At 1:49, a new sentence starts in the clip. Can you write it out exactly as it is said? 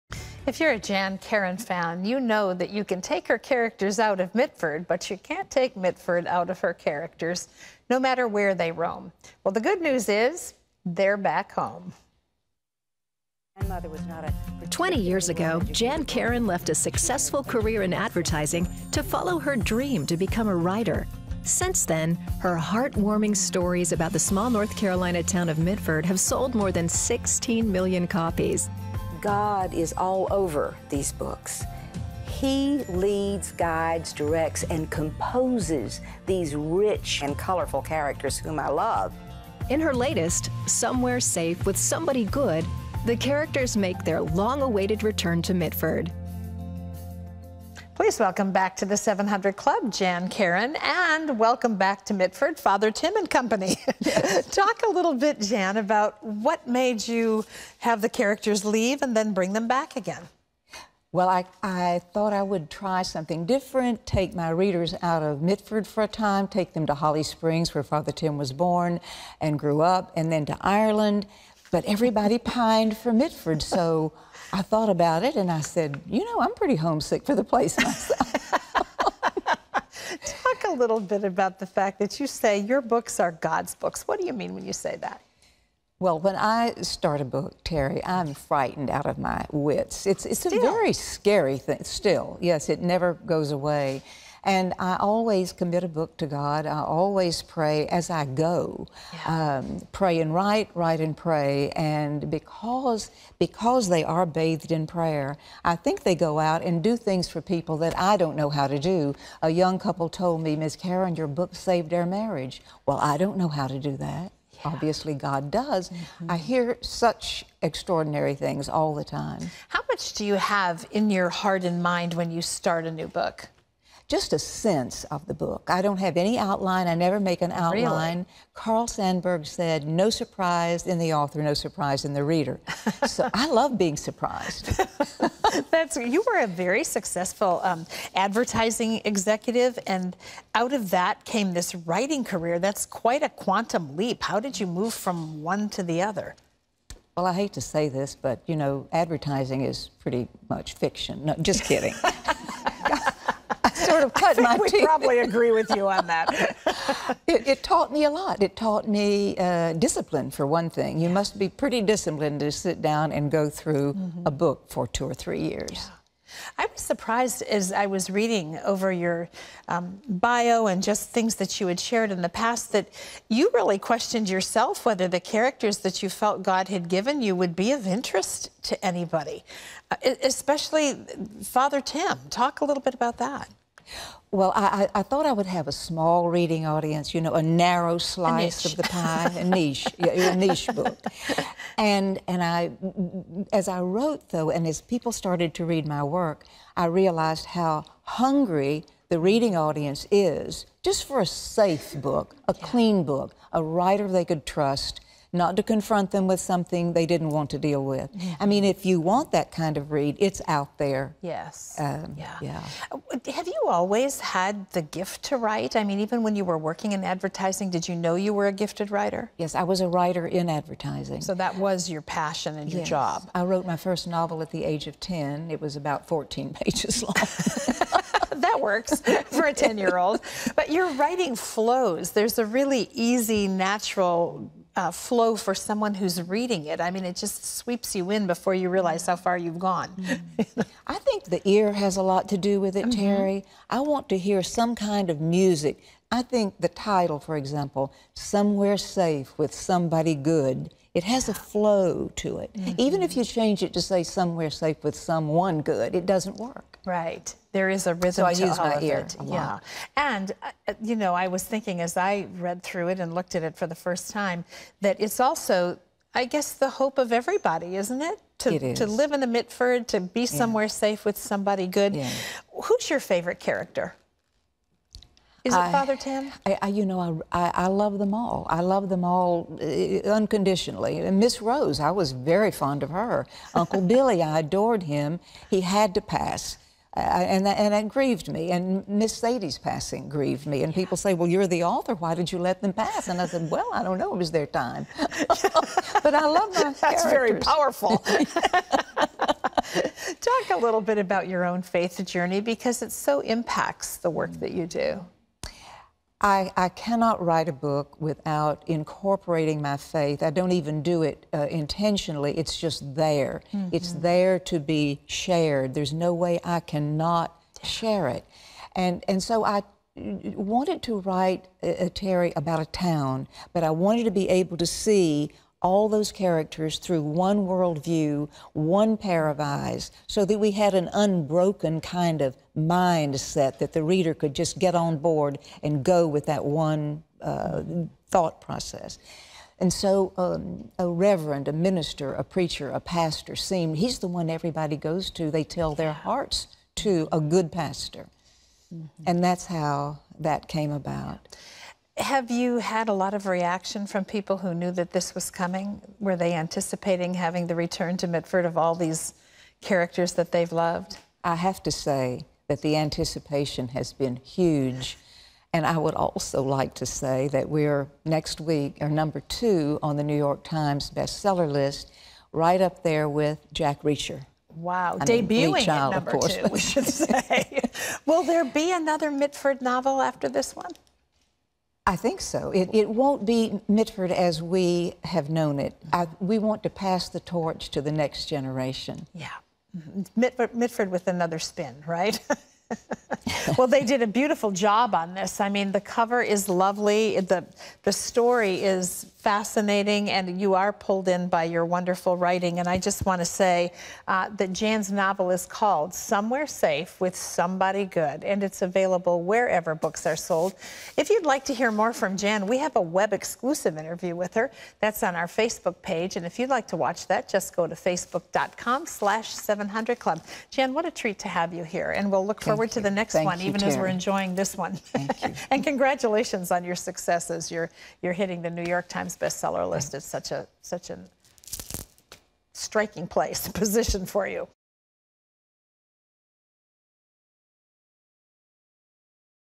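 A young couple told me, Miss Karon, your book saved our marriage.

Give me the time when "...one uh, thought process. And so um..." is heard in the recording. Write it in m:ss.
5:36.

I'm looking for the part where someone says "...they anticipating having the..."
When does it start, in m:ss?
5:56.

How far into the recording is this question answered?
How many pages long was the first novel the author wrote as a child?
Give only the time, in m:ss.
3:46.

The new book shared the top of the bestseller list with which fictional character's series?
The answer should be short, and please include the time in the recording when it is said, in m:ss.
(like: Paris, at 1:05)
Jack Reacher, at 6:13.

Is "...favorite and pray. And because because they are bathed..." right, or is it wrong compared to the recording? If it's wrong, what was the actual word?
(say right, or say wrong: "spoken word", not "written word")
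wrong: "write", not "favorite".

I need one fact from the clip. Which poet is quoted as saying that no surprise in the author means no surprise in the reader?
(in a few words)
Carl Sandburg.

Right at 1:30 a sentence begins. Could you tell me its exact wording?
It's, it's a very scary thing, still.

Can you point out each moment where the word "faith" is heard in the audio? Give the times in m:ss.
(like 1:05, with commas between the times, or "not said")
5:01, 5:09.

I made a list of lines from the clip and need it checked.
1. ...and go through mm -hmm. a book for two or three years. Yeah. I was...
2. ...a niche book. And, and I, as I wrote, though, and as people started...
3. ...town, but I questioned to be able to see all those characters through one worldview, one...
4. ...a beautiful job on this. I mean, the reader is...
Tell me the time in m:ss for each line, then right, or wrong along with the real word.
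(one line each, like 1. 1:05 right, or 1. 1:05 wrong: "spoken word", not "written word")
1. 2:43 right
2. 3:10 right
3. 5:22 wrong: "wanted", not "questioned"
4. 6:34 wrong: "cover", not "reader".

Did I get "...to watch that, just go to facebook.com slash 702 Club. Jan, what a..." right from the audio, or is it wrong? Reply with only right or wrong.
wrong.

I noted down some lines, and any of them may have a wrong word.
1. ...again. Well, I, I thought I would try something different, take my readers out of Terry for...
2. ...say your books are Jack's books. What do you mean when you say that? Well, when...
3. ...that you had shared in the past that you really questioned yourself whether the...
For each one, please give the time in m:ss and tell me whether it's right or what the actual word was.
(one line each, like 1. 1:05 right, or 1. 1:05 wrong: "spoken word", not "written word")
1. 0:59 wrong: "Mitford", not "Terry"
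2. 1:22 wrong: "God", not "Jack"
3. 2:51 right.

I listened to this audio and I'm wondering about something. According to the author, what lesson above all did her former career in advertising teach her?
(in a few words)
Discipline.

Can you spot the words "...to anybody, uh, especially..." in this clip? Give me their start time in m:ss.
2:58.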